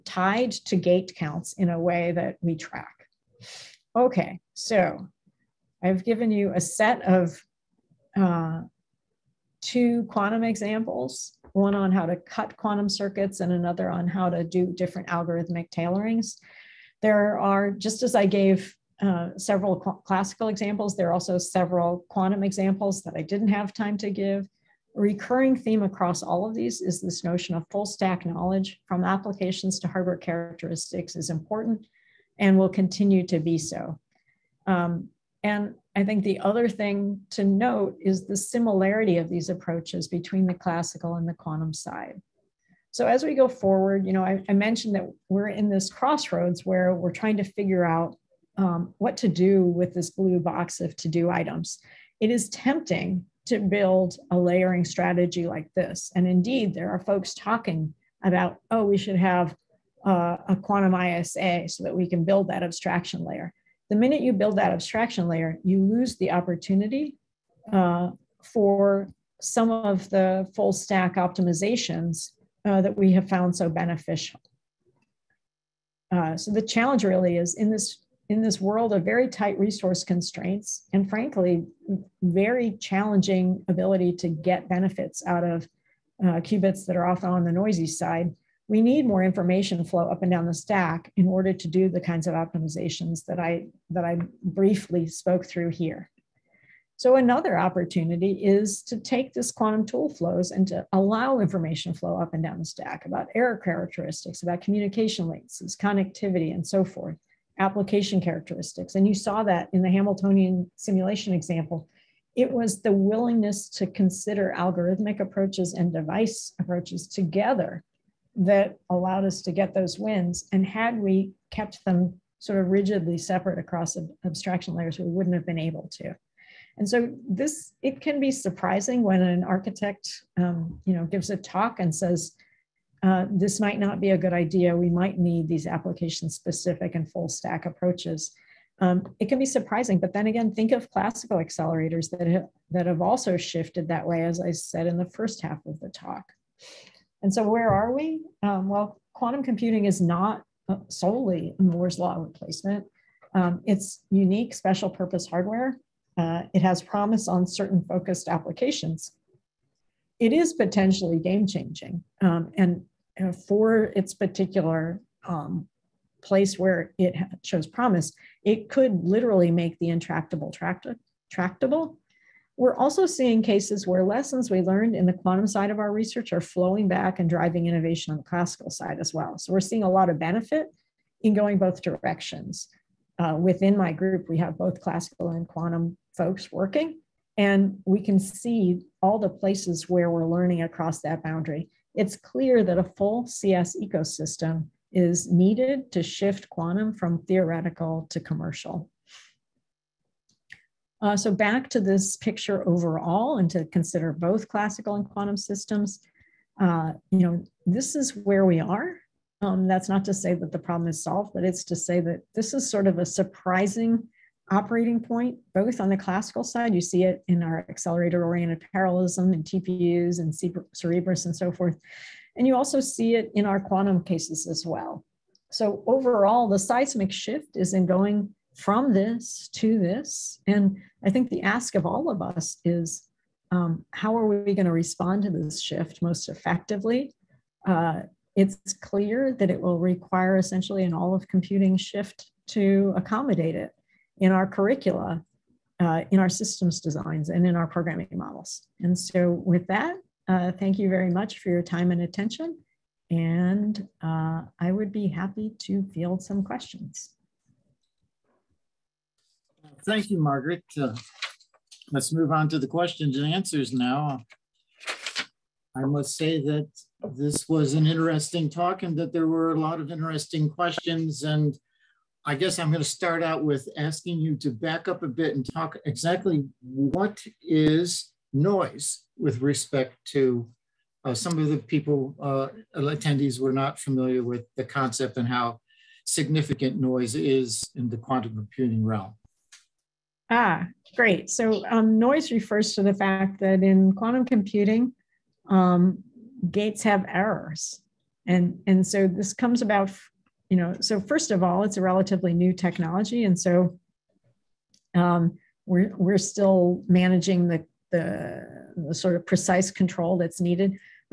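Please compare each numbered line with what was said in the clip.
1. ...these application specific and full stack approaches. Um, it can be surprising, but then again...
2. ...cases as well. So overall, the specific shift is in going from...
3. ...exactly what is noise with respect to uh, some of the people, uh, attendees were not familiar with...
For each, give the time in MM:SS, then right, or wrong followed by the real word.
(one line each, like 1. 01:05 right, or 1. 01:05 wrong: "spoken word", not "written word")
1. 02:15 right
2. 03:44 wrong: "seismic", not "specific"
3. 04:35 right.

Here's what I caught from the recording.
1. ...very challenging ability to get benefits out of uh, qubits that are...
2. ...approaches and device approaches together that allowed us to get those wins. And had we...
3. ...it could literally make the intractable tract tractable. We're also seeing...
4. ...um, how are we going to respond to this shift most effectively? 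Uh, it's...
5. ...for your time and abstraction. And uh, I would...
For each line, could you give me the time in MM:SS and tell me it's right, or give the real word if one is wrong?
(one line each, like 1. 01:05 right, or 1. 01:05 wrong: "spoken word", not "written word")
1. 01:22 right
2. 01:55 right
3. 02:48 right
4. 03:53 right
5. 04:11 wrong: "attention", not "abstraction".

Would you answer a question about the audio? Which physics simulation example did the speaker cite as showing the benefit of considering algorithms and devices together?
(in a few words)
Hamiltonian simulation.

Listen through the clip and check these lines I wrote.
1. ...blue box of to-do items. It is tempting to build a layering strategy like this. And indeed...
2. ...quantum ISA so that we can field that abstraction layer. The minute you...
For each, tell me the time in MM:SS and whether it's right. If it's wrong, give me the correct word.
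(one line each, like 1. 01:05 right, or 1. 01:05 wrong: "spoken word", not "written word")
1. 00:50 right
2. 01:00 wrong: "build", not "field".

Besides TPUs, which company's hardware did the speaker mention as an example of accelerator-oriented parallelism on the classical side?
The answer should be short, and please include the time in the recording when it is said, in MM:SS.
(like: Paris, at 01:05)
Cerebras, at 03:40.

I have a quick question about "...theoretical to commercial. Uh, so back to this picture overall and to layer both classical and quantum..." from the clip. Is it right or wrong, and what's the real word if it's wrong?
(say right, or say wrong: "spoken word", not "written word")
wrong: "consider", not "layer".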